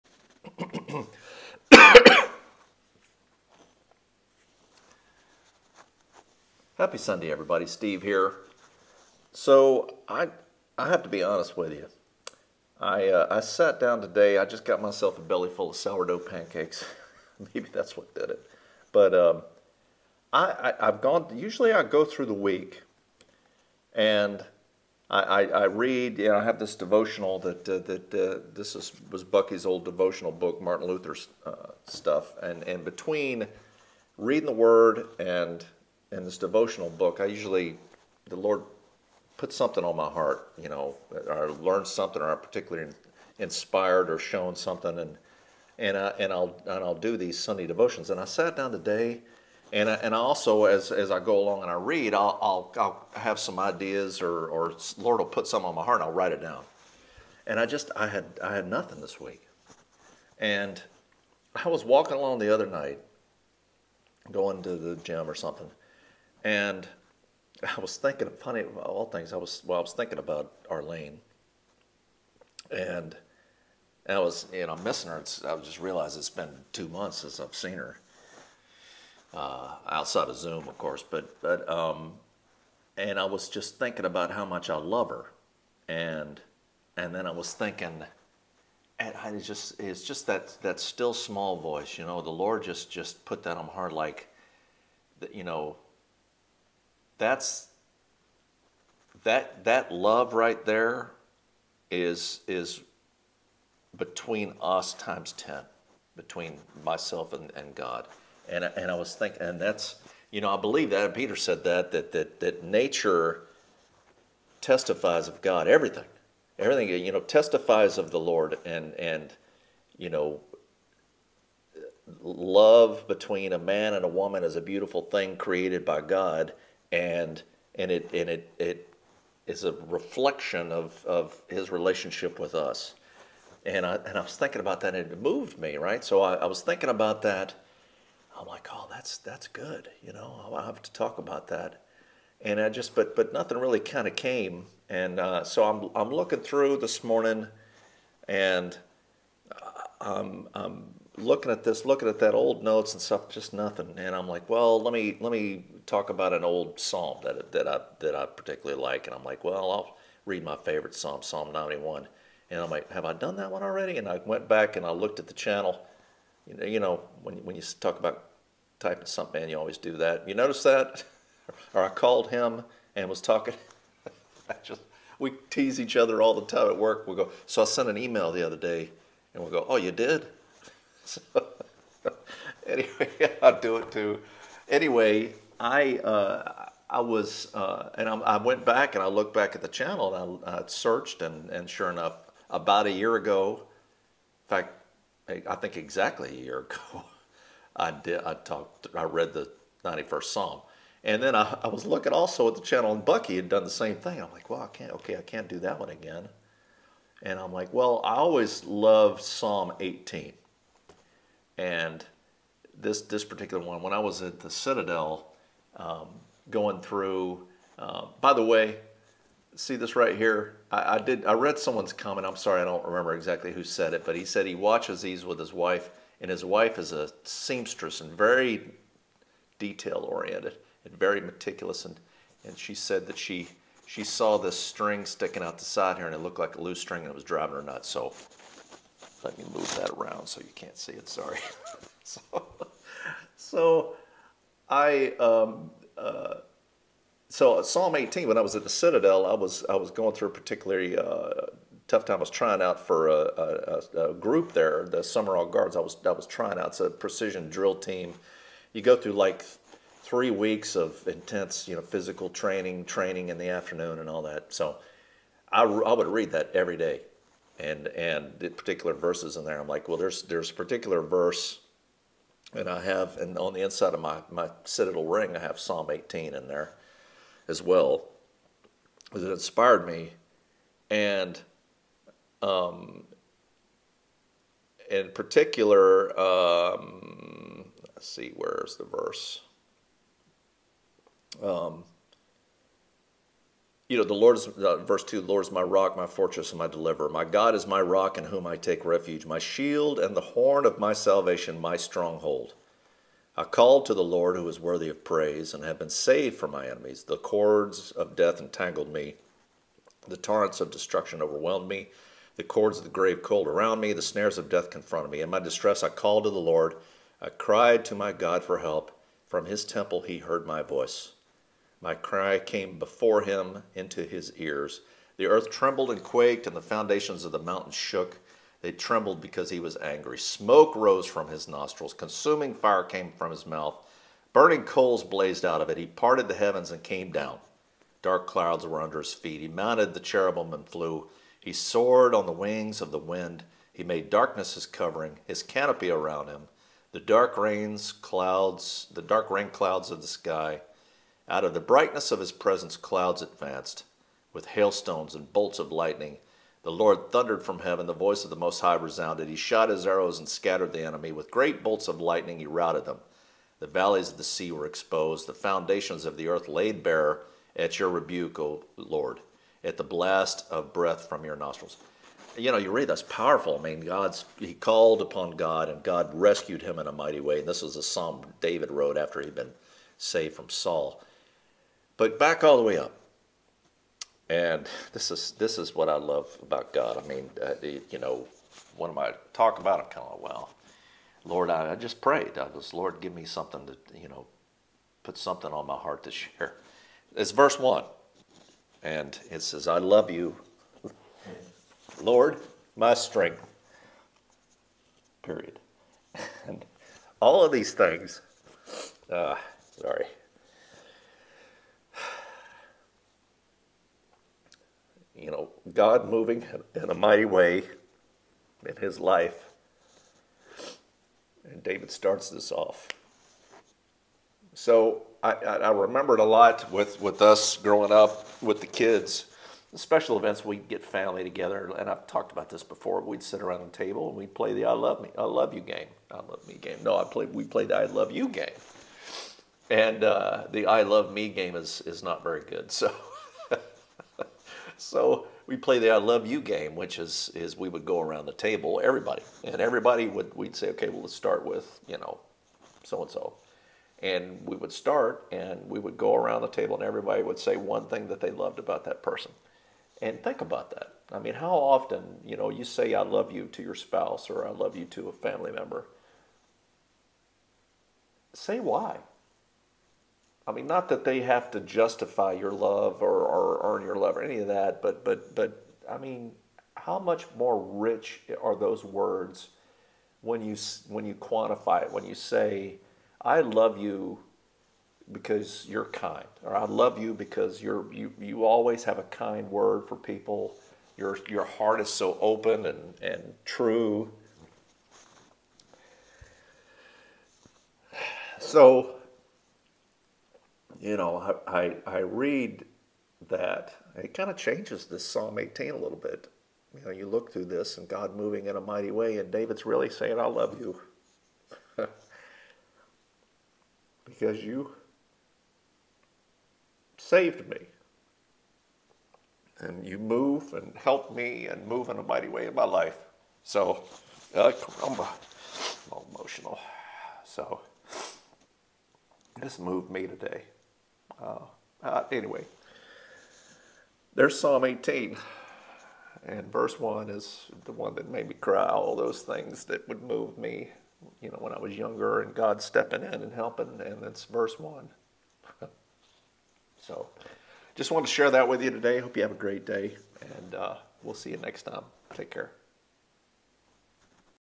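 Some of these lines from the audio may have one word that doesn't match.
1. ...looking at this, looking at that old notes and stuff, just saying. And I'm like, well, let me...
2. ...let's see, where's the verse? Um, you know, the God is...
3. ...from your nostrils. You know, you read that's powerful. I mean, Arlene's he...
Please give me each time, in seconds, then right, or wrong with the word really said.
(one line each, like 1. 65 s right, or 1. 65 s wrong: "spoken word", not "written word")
1. 151 s wrong: "nothing", not "saying"
2. 287 s wrong: "Lord", not "God"
3. 371 s wrong: "God", not "Arlene".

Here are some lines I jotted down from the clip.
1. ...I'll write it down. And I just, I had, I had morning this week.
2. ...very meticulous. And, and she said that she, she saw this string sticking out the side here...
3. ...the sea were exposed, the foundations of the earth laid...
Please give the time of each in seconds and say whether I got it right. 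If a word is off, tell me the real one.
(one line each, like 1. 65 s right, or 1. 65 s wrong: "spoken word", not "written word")
1. 56 s wrong: "nothing", not "morning"
2. 230 s right
3. 364 s right.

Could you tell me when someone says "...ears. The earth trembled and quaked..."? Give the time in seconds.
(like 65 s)
324 s.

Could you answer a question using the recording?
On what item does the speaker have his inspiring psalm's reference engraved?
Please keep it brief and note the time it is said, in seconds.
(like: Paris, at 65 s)
Citadel ring, at 274 s.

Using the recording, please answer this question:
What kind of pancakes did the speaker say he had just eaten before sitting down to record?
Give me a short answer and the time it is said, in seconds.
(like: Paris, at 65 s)
Sourdough, at 15 s.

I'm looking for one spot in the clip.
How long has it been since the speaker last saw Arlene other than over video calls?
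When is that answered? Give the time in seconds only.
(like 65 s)
76 s.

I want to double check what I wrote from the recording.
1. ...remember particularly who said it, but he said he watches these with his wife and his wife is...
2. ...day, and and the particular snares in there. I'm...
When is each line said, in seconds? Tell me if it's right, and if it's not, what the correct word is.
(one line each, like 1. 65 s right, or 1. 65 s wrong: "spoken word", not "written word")
1. 222 s wrong: "exactly", not "particularly"
2. 266 s wrong: "verses", not "snares".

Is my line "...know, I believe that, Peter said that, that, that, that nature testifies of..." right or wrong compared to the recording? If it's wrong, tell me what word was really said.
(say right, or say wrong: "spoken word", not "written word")
right.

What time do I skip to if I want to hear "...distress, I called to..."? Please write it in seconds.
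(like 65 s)
315 s.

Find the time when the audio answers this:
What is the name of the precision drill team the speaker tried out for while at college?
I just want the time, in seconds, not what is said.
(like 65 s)
254 s.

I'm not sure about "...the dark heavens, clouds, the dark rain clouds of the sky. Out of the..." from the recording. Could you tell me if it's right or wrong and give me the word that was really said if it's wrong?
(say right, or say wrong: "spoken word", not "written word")
wrong: "rains", not "heavens".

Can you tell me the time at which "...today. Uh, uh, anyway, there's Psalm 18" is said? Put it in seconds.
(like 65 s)
530 s.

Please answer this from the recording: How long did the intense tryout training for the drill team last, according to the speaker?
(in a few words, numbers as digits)
Three weeks.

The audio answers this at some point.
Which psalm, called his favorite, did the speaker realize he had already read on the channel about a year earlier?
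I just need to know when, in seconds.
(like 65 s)
161 s.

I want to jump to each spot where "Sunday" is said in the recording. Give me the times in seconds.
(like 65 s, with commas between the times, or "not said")
6 s, 47 s.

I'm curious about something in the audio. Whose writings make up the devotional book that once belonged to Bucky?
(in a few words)
Martin Luther.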